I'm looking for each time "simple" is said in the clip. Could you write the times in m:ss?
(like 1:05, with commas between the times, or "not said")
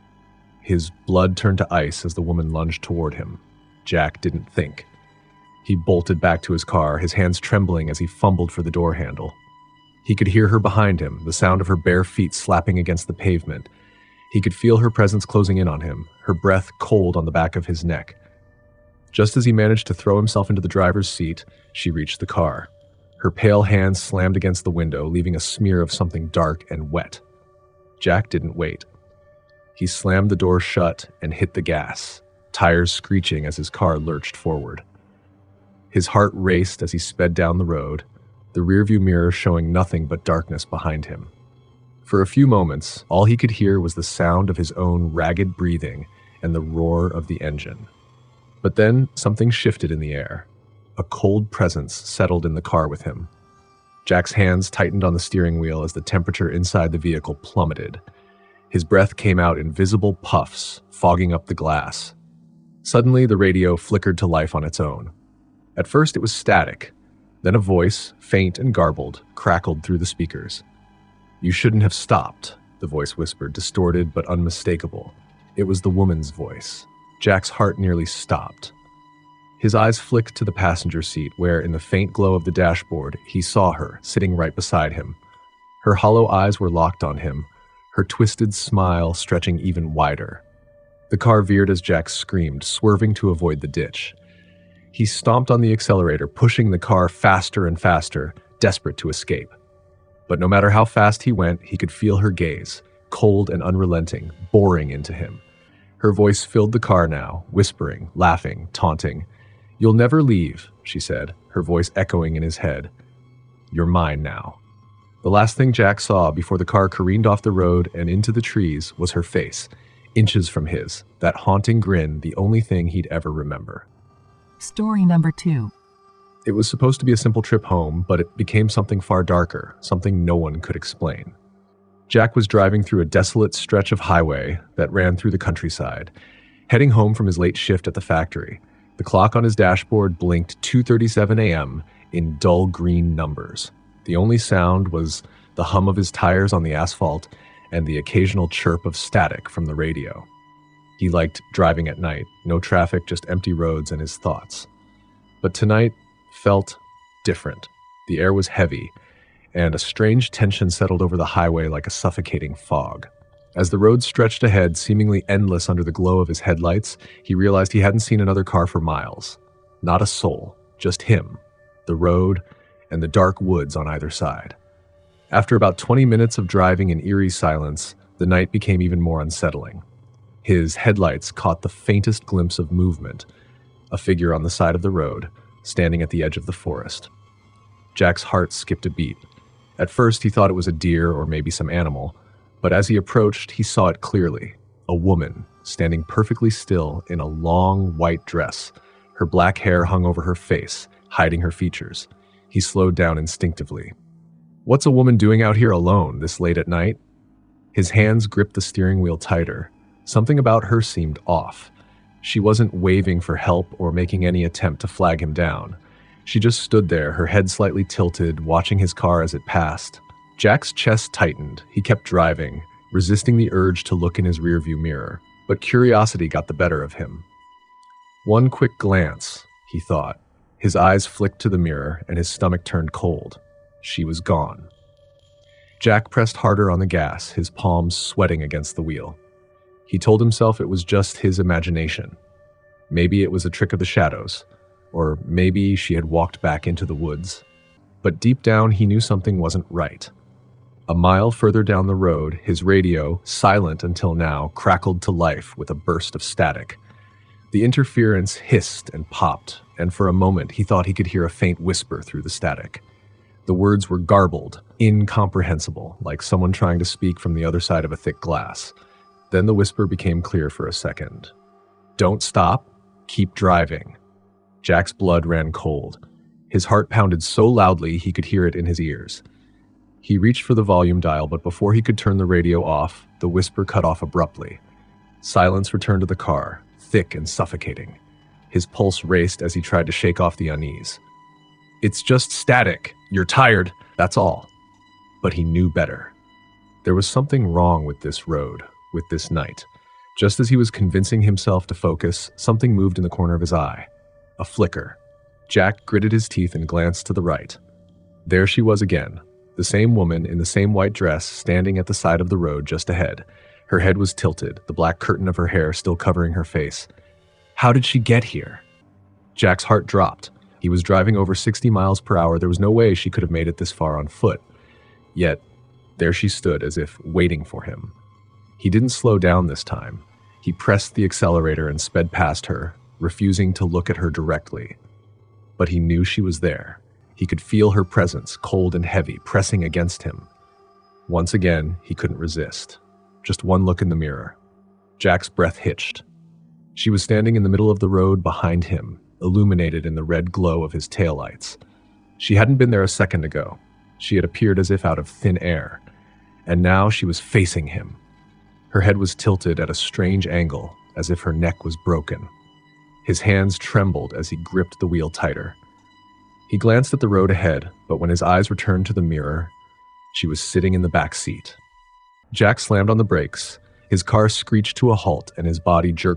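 2:07.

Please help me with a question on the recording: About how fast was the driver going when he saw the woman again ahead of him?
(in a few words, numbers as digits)
over 60 mph.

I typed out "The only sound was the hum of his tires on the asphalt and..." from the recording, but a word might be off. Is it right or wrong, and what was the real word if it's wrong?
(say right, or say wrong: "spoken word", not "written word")
right.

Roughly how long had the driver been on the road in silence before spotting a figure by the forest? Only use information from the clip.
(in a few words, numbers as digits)
20 minutes.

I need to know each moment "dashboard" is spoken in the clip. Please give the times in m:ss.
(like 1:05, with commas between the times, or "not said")
1:22, 2:19.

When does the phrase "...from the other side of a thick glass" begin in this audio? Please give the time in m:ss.
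4:27.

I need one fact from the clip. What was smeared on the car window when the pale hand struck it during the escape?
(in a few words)
something dark and wet.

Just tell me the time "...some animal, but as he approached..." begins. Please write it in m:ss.
3:11.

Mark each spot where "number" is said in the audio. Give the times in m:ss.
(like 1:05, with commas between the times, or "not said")
2:05, 2:23.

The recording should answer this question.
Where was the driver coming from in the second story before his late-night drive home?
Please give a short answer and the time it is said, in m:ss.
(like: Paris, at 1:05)
the factory, at 2:17.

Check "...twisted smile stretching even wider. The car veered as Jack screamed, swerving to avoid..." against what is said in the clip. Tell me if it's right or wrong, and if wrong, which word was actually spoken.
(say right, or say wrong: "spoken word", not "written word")
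right.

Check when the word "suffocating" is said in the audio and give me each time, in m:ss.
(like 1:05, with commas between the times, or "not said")
2:41, 4:47.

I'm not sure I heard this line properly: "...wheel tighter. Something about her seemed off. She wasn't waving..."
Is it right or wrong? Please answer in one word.
right.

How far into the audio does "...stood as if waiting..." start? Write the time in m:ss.
5:26.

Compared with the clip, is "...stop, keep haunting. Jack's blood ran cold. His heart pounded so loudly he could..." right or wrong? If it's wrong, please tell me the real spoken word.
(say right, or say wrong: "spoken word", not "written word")
wrong: "driving", not "haunting".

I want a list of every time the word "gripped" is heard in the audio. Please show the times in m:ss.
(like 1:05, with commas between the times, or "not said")
3:28, 6:04.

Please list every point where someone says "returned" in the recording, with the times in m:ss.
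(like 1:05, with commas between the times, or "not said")
4:45, 6:08.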